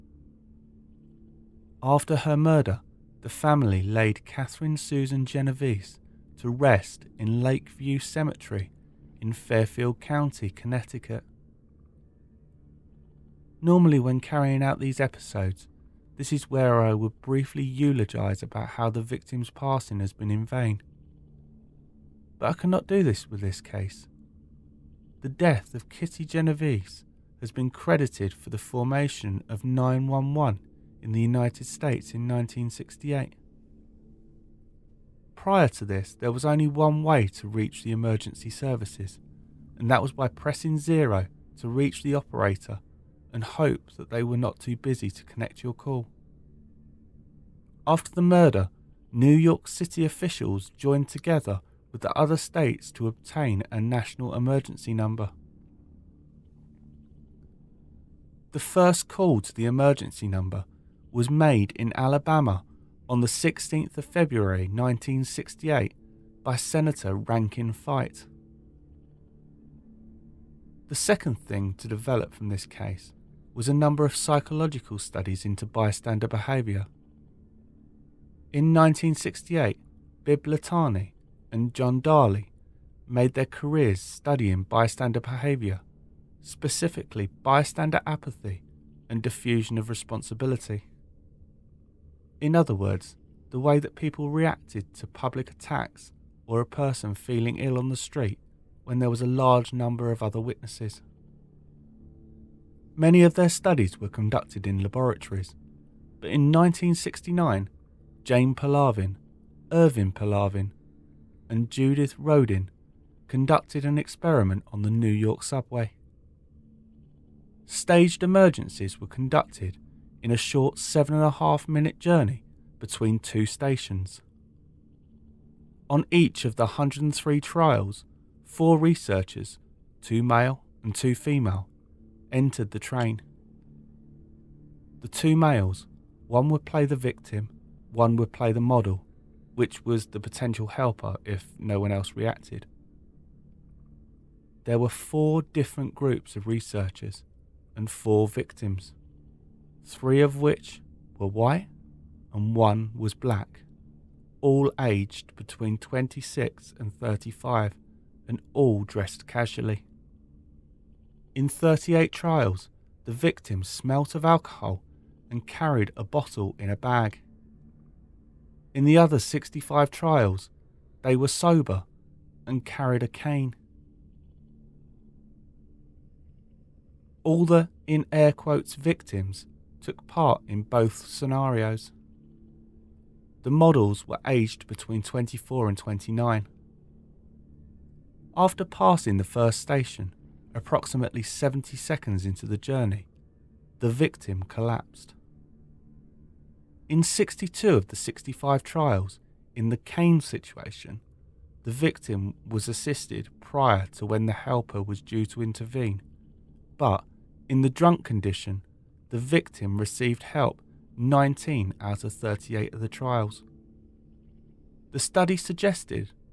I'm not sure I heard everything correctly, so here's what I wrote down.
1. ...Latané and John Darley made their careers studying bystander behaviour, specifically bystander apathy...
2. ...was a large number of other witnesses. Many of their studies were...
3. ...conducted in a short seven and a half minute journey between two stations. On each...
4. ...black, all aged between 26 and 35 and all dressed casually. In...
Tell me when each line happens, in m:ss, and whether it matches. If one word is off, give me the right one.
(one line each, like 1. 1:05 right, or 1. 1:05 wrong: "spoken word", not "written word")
1. 1:20 right
2. 1:39 right
3. 1:59 right
4. 2:33 right.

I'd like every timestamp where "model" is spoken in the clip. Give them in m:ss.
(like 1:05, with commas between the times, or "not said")
2:18, 3:03.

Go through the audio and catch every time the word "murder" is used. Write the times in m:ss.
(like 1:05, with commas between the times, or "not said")
0:02, 0:48.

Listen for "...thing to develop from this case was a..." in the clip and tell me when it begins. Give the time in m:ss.
1:11.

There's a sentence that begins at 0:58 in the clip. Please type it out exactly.
The first call to the emergency number was made in Alabama on the 16th of February 1968 by Senator Rankin Fite.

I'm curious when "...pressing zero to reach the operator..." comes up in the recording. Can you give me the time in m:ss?
0:40.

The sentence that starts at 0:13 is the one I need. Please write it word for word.
Normally, when carrying out these episodes, this is where I would briefly eulogise about how the victim's passing has been in vain.